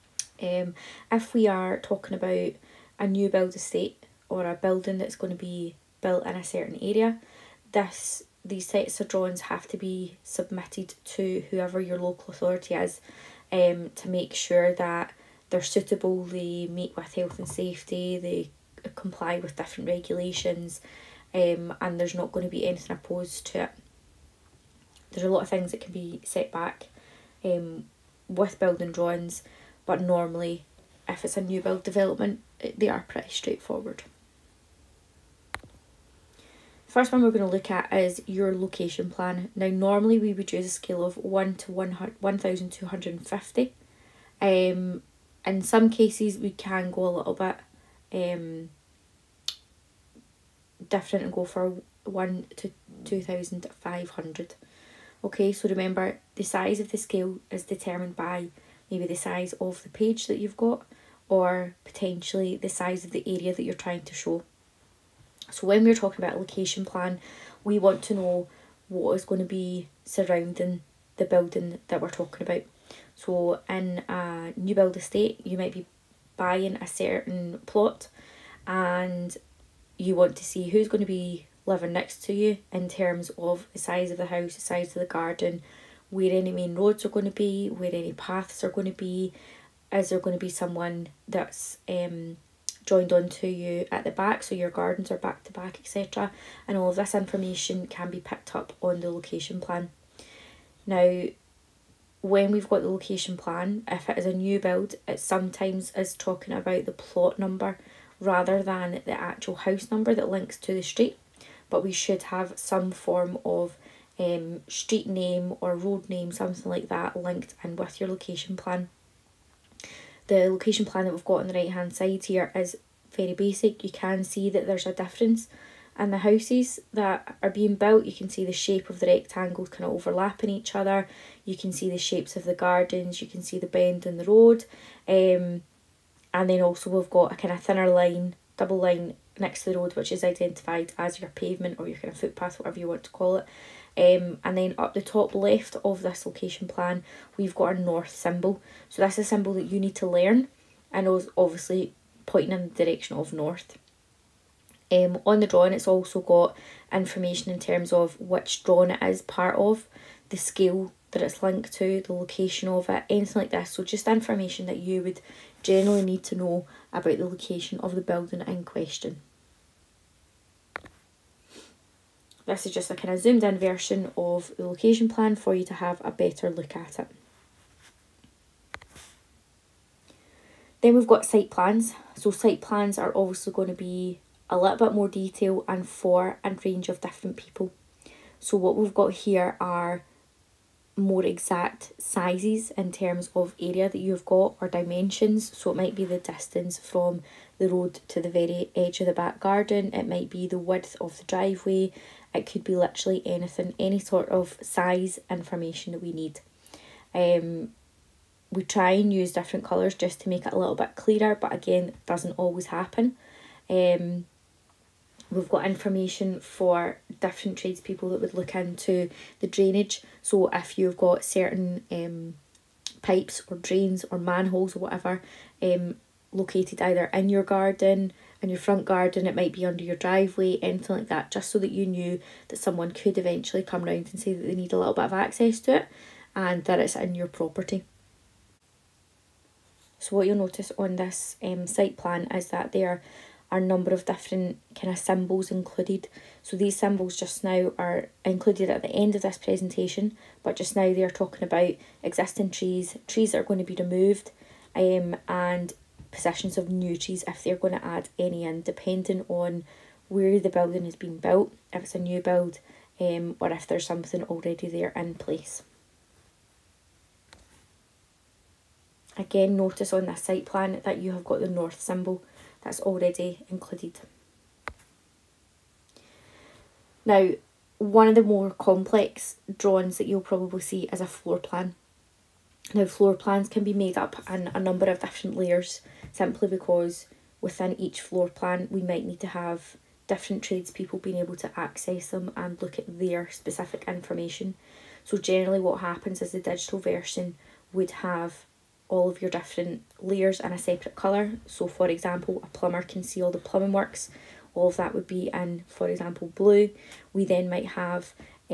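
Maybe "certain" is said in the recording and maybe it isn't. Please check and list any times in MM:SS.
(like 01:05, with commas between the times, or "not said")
00:06, 01:16, 03:41.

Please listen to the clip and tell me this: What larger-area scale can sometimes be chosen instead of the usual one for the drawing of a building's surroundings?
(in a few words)
1 to 2,500.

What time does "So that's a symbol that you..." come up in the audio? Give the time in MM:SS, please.
02:28.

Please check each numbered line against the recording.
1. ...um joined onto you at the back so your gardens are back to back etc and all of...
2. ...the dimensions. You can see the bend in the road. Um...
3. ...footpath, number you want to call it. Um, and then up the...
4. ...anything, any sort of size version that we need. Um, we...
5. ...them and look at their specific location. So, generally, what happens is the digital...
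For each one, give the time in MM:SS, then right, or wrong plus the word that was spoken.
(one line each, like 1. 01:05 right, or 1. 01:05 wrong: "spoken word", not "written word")
1. 01:31 right
2. 02:12 wrong: "gardens", not "dimensions"
3. 02:22 wrong: "whatever", not "number"
4. 03:23 wrong: "information", not "version"
5. 04:52 wrong: "information", not "location".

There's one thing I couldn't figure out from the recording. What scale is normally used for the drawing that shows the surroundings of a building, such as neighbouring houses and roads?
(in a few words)
1 to 1,250.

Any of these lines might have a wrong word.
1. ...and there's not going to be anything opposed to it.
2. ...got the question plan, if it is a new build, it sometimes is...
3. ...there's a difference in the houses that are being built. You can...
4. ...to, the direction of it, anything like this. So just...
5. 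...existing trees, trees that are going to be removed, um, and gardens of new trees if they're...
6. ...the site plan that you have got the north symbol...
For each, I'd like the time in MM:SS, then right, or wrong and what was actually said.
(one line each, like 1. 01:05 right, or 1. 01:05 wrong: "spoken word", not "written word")
1. 00:21 right
2. 01:42 wrong: "location", not "question"
3. 02:04 right
4. 02:41 wrong: "location", not "direction"
5. 04:12 wrong: "possessions", not "gardens"
6. 04:30 right.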